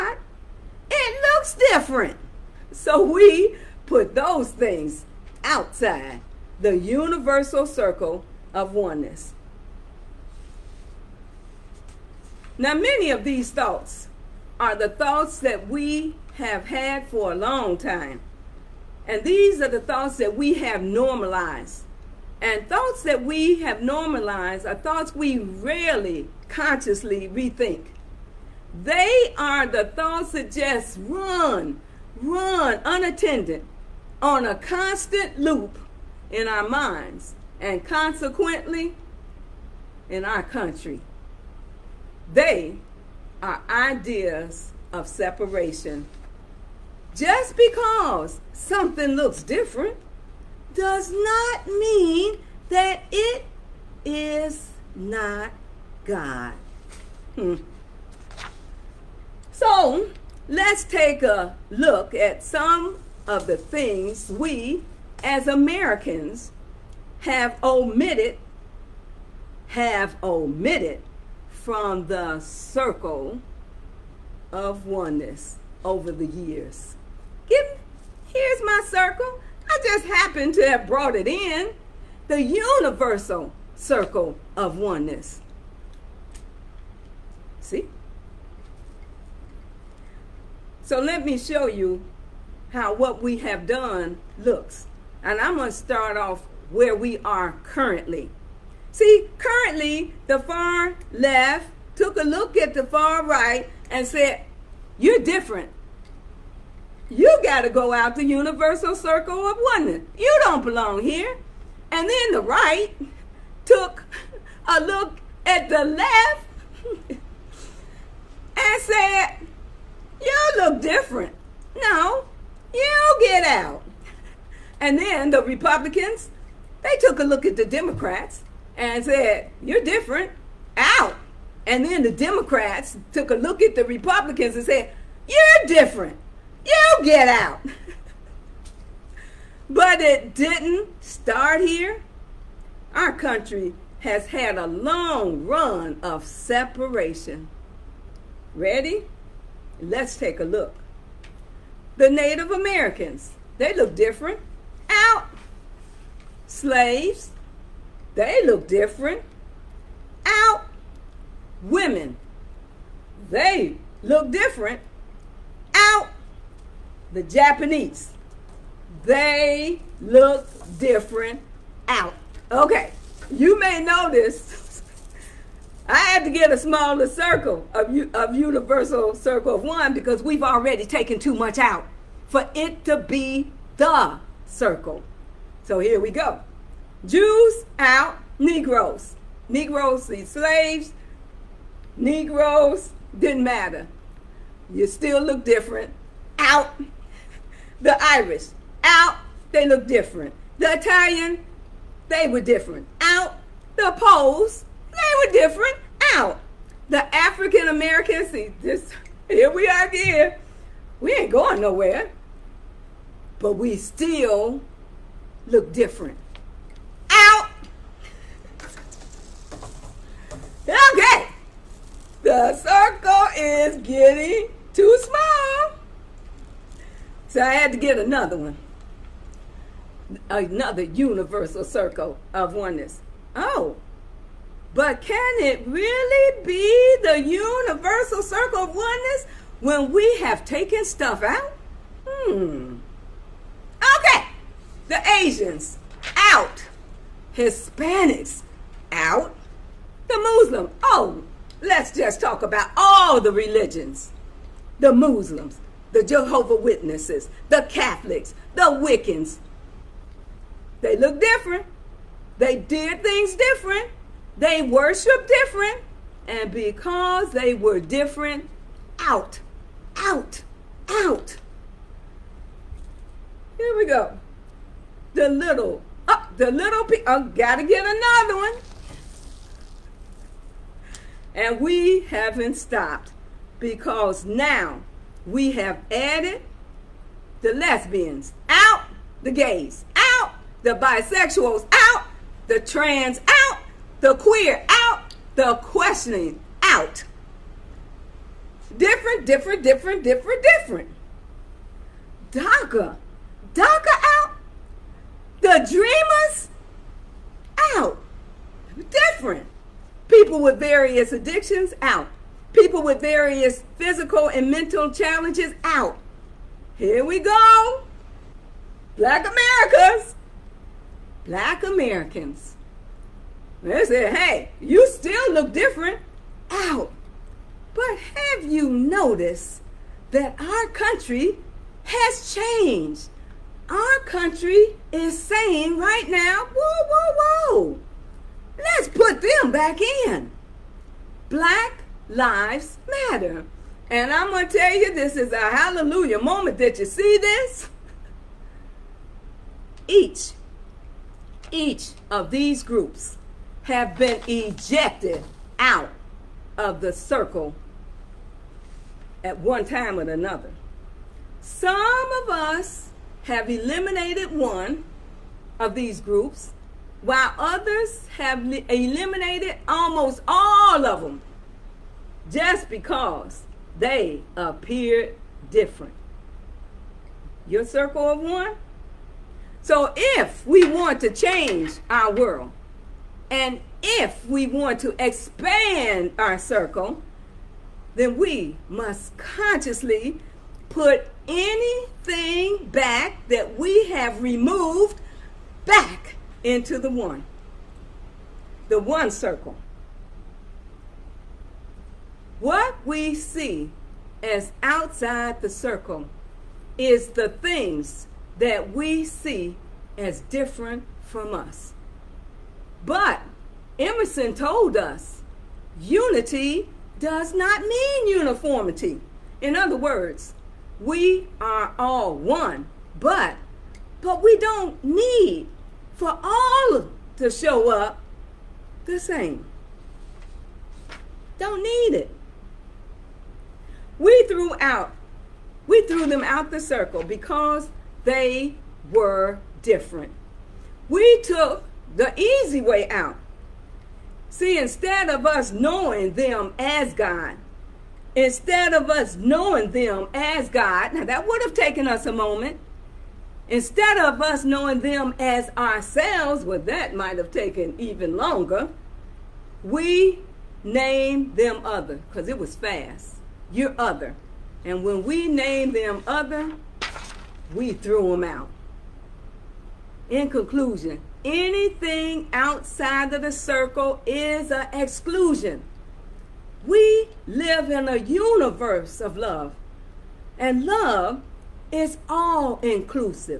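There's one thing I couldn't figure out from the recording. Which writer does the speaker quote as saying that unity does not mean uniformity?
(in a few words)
Emerson.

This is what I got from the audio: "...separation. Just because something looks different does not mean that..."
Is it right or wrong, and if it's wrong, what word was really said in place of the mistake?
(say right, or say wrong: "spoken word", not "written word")
right.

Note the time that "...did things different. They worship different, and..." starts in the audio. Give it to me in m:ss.
4:22.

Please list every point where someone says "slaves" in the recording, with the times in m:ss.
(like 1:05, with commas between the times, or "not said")
2:36, 3:10.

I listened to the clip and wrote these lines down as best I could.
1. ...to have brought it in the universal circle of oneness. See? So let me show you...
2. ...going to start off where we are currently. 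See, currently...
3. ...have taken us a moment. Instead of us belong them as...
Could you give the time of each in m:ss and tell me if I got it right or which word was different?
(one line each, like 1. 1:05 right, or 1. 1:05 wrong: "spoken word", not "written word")
1. 1:20 right
2. 1:35 right
3. 7:31 wrong: "knowing", not "belong".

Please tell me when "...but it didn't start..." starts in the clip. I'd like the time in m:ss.
2:19.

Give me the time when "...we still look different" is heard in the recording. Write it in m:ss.
3:33.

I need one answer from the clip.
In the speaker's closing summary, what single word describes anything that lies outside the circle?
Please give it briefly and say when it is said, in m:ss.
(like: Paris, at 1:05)
exclusion, at 7:54.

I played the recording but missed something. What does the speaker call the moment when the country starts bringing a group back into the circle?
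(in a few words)
a hallelujah moment.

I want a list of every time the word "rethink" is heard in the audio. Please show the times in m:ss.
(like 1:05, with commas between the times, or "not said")
0:27.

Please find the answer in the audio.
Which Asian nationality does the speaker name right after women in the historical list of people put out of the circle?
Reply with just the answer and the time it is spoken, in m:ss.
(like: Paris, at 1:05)
The Japanese, at 2:47.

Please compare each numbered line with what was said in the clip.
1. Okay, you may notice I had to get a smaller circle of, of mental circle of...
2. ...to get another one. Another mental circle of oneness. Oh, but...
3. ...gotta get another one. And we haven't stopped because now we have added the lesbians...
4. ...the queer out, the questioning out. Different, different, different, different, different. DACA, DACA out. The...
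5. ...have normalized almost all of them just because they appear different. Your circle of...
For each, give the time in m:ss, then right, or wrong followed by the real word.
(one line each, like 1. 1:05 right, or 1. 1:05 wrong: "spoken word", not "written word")
1. 2:52 wrong: "universal", not "mental"
2. 3:47 wrong: "universal", not "mental"
3. 4:37 right
4. 4:54 right
5. 6:08 wrong: "eliminated", not "normalized".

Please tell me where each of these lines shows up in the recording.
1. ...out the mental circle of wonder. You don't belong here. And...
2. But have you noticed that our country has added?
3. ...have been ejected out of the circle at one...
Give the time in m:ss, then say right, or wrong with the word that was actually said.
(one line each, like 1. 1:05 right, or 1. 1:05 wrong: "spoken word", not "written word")
1. 1:47 wrong: "universal", not "mental"
2. 5:27 wrong: "changed", not "added"
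3. 5:53 right.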